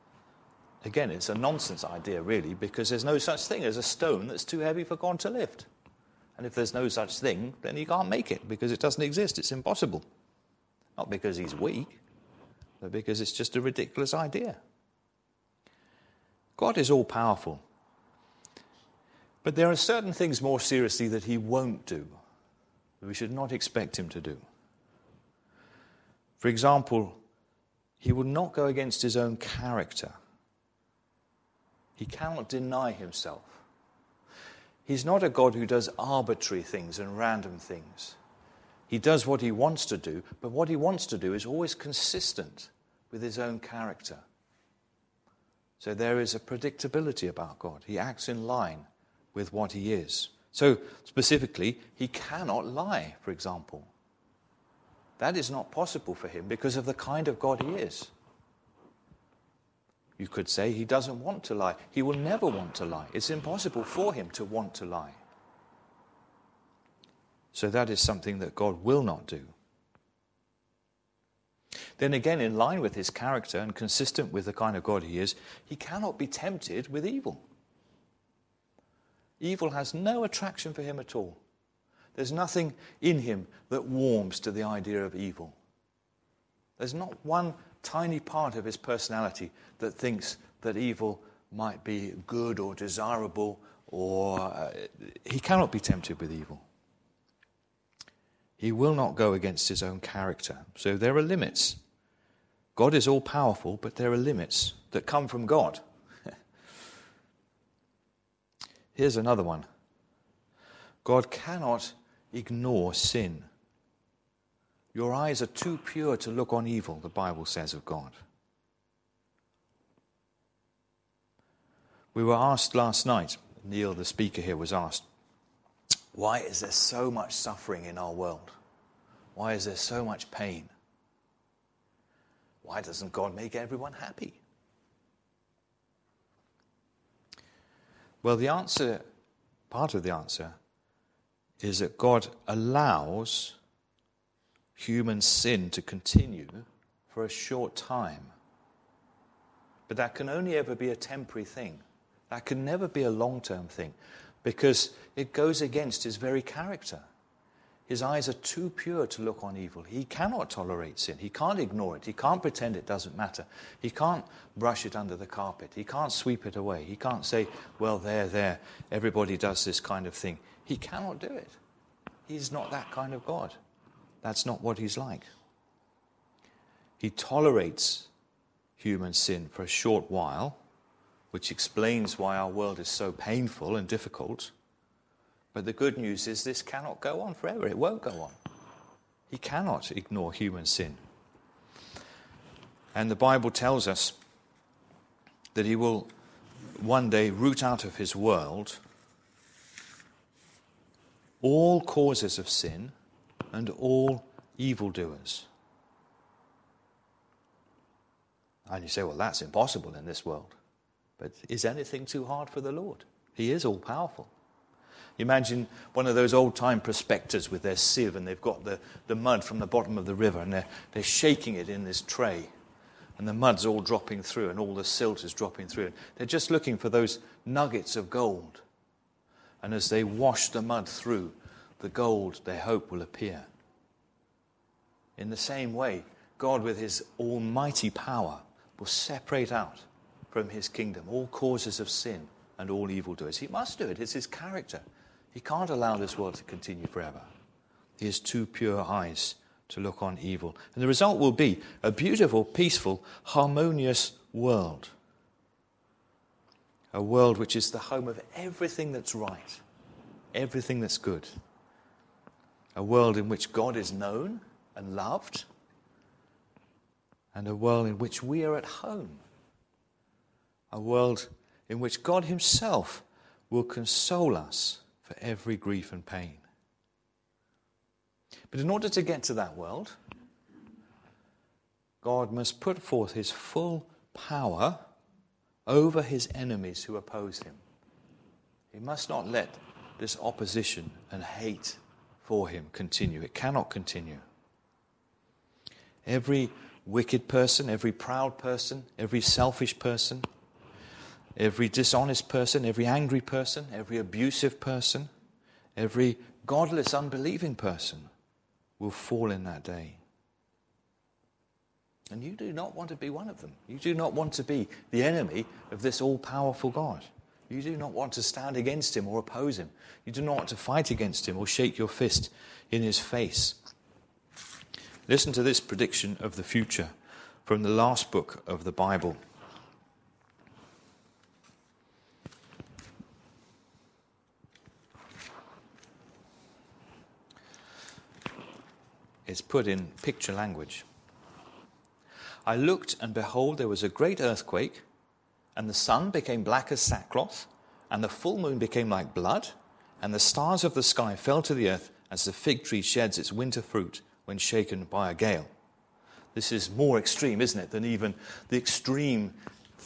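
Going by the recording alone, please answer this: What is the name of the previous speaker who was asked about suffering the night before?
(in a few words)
Neil.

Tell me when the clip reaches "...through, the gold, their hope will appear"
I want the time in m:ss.
3:50.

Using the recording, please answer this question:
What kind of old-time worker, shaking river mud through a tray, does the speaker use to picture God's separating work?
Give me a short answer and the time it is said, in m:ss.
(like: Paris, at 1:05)
prospectors, at 3:36.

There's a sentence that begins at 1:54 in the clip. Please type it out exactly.
Your eyes are too pure to look on evil, the Bible says of God.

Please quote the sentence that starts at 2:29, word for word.
But that can only ever be a temporary thing.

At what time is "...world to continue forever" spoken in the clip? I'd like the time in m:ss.
4:06.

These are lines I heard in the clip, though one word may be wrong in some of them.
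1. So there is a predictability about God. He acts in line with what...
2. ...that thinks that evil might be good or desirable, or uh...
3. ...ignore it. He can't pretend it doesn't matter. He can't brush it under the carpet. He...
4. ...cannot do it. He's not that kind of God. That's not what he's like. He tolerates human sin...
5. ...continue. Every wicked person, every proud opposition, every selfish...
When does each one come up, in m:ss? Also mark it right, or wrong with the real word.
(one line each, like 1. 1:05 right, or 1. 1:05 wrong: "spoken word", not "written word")
1. 0:45 right
2. 1:29 right
3. 2:41 right
4. 2:50 right
5. 4:53 wrong: "person", not "opposition".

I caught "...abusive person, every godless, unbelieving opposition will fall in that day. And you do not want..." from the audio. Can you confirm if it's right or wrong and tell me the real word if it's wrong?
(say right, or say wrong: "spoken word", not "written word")
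wrong: "person", not "opposition".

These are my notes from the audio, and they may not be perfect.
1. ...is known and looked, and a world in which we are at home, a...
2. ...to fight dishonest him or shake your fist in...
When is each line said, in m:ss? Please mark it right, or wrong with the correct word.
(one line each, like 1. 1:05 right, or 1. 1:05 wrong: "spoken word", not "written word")
1. 4:23 wrong: "loved", not "looked"
2. 5:20 wrong: "against", not "dishonest".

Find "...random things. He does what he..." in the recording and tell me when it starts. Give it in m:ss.
0:37.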